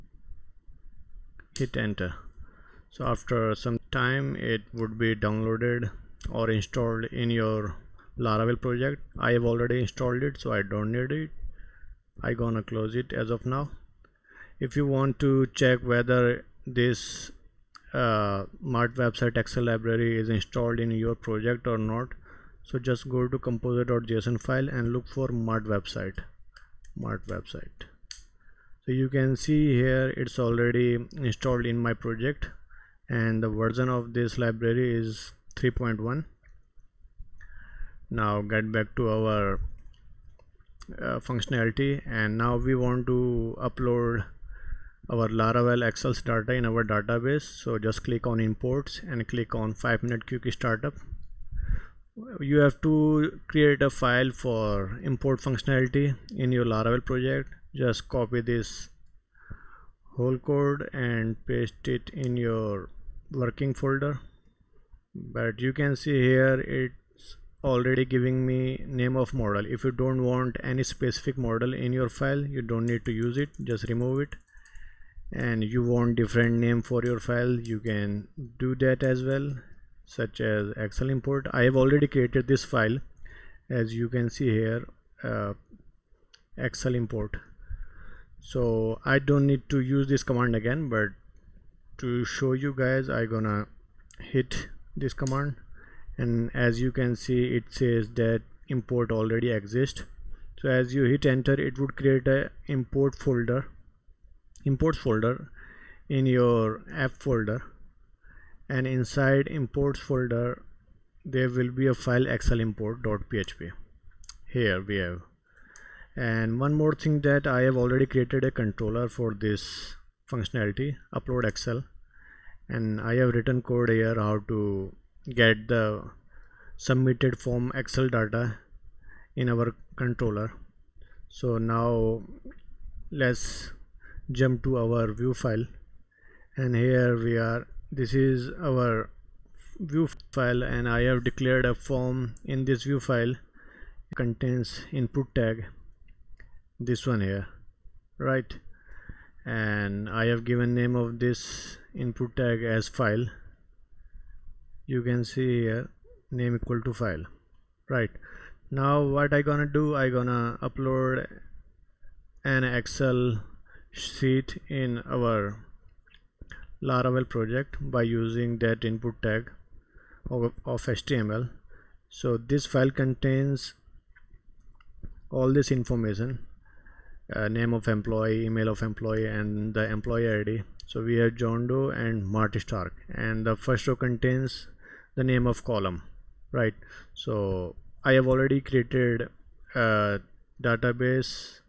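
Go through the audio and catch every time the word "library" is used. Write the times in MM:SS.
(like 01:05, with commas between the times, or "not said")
00:19, 00:34.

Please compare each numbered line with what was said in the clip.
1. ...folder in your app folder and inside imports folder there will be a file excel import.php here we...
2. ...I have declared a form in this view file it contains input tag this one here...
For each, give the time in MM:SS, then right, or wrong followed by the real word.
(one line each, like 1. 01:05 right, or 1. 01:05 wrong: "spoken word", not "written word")
1. 01:45 right
2. 02:20 right.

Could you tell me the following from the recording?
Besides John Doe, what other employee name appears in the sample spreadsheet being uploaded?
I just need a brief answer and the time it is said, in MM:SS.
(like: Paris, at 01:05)
Marty Stark, at 03:02.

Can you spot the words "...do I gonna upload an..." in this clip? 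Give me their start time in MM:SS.
02:39.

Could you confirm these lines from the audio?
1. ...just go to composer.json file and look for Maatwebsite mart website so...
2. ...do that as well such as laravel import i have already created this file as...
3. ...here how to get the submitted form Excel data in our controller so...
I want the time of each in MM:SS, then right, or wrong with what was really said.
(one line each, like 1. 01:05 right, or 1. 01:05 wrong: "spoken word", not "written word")
1. 00:22 right
2. 01:18 wrong: "excel", not "laravel"
3. 02:03 right.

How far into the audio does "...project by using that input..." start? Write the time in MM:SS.
02:47.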